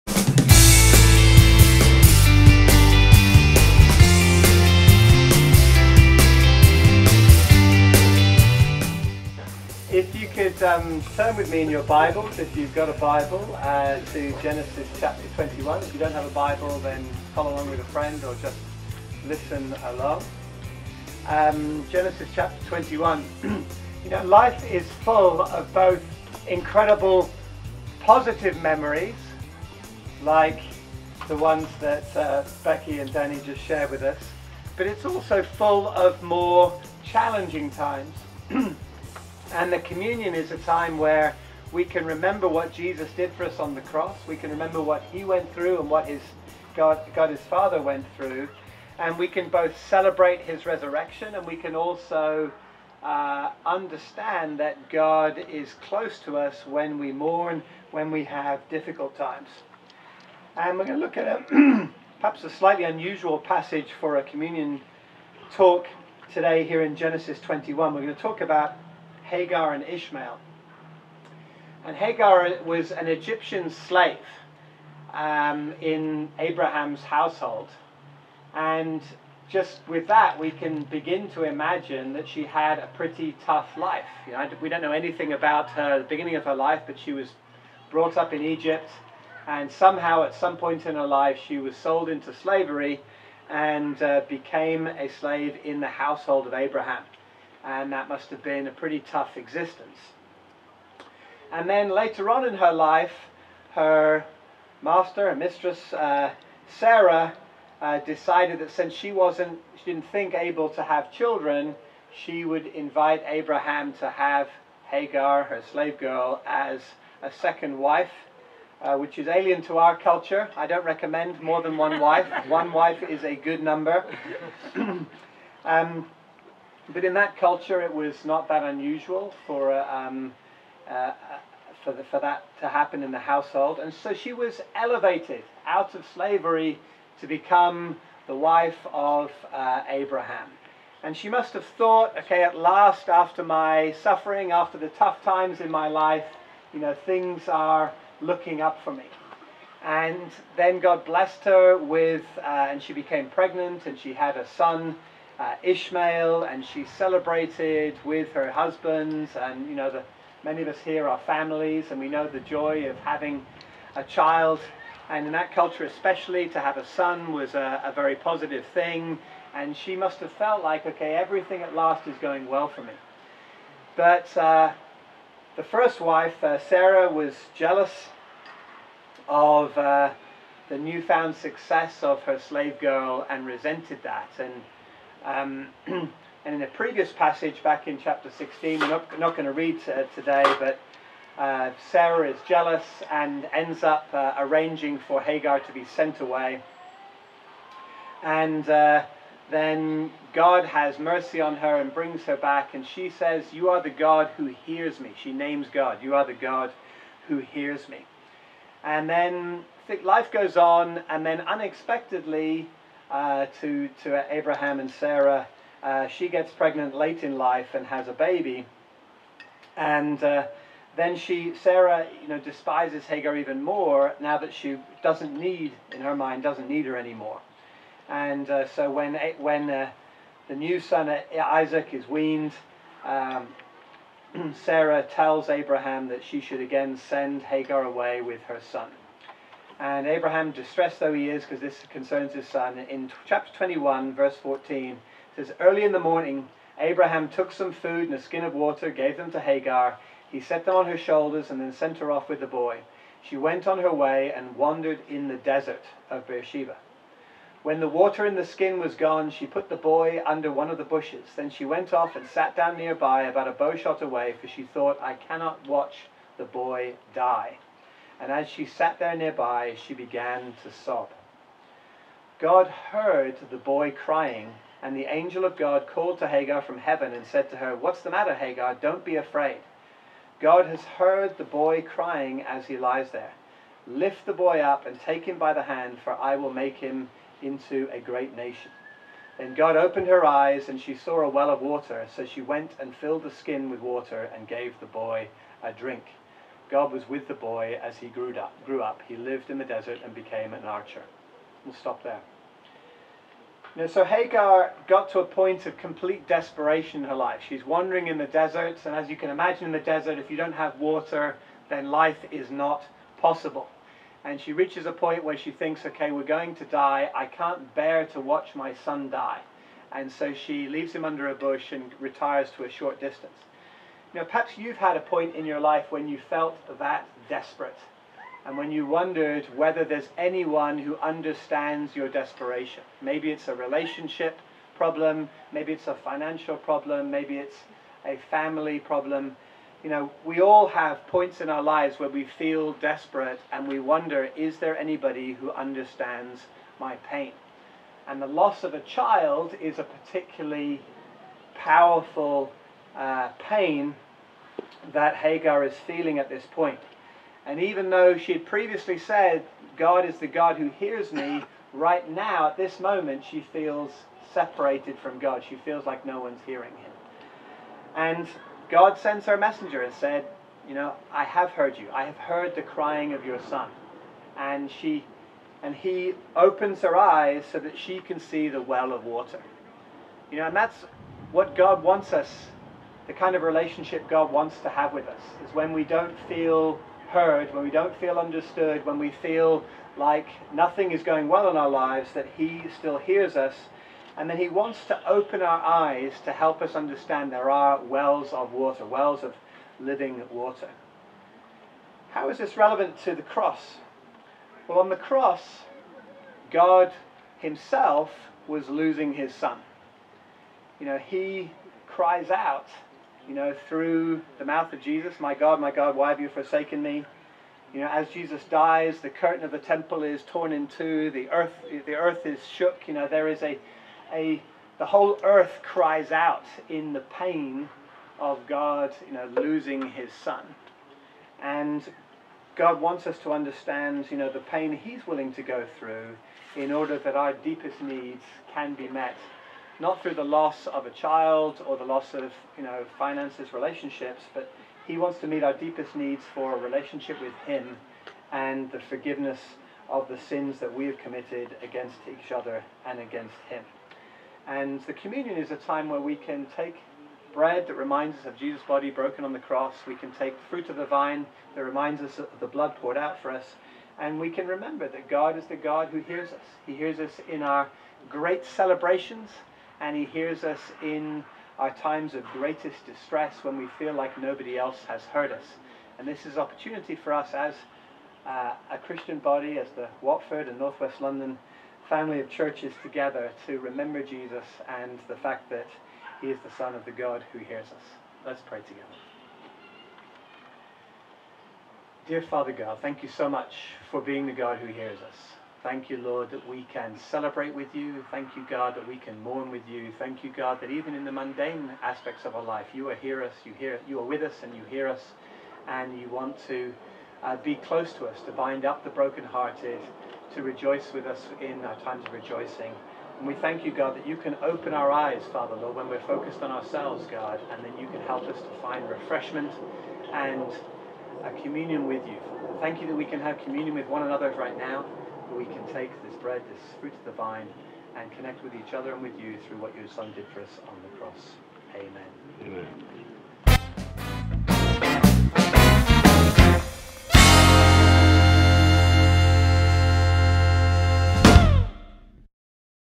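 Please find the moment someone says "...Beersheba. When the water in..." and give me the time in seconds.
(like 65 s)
256 s.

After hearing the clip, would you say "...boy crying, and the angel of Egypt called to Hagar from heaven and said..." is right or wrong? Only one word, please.
wrong.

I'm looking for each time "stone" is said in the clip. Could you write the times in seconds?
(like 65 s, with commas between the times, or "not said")
not said.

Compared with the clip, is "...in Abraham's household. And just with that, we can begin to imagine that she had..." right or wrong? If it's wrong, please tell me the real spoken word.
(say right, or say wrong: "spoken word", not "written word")
right.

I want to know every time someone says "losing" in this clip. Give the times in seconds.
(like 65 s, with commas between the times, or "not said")
408 s, 429 s.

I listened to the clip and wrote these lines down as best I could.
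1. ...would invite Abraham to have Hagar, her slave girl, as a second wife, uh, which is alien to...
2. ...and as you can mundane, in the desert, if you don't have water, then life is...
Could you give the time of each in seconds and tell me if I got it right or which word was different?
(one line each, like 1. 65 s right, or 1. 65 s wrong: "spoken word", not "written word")
1. 112 s right
2. 308 s wrong: "imagine", not "mundane".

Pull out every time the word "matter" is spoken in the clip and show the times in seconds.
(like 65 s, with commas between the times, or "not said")
278 s.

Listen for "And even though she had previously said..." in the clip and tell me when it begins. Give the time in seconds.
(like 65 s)
357 s.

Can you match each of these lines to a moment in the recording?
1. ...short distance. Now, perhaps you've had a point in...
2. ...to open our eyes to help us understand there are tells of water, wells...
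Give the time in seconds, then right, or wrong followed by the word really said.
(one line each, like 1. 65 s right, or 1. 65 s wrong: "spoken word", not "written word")
1. 322 s right
2. 394 s wrong: "wells", not "tells".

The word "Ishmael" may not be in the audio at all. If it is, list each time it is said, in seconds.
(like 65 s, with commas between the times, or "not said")
69 s, 155 s.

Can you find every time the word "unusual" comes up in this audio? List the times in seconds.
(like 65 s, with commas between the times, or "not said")
62 s, 128 s.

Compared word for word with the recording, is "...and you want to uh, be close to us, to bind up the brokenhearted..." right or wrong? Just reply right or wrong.
right.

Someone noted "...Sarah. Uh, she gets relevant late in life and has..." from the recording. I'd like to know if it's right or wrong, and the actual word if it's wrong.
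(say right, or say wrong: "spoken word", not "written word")
wrong: "pregnant", not "relevant".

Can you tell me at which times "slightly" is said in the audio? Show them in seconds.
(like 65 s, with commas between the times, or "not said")
62 s.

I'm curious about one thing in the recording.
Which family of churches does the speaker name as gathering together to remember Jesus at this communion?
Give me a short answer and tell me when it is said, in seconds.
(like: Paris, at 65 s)
Watford and Northwest London, at 480 s.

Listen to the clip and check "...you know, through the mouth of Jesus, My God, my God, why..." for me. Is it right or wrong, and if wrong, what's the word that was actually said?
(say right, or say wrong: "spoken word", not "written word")
right.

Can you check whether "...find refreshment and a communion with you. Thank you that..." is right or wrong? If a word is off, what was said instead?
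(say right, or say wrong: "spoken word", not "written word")
right.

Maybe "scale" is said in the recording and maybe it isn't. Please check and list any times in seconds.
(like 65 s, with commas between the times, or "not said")
not said.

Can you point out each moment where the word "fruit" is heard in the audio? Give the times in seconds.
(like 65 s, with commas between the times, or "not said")
460 s, 526 s.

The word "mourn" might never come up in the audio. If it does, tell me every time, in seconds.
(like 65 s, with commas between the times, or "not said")
57 s, 499 s.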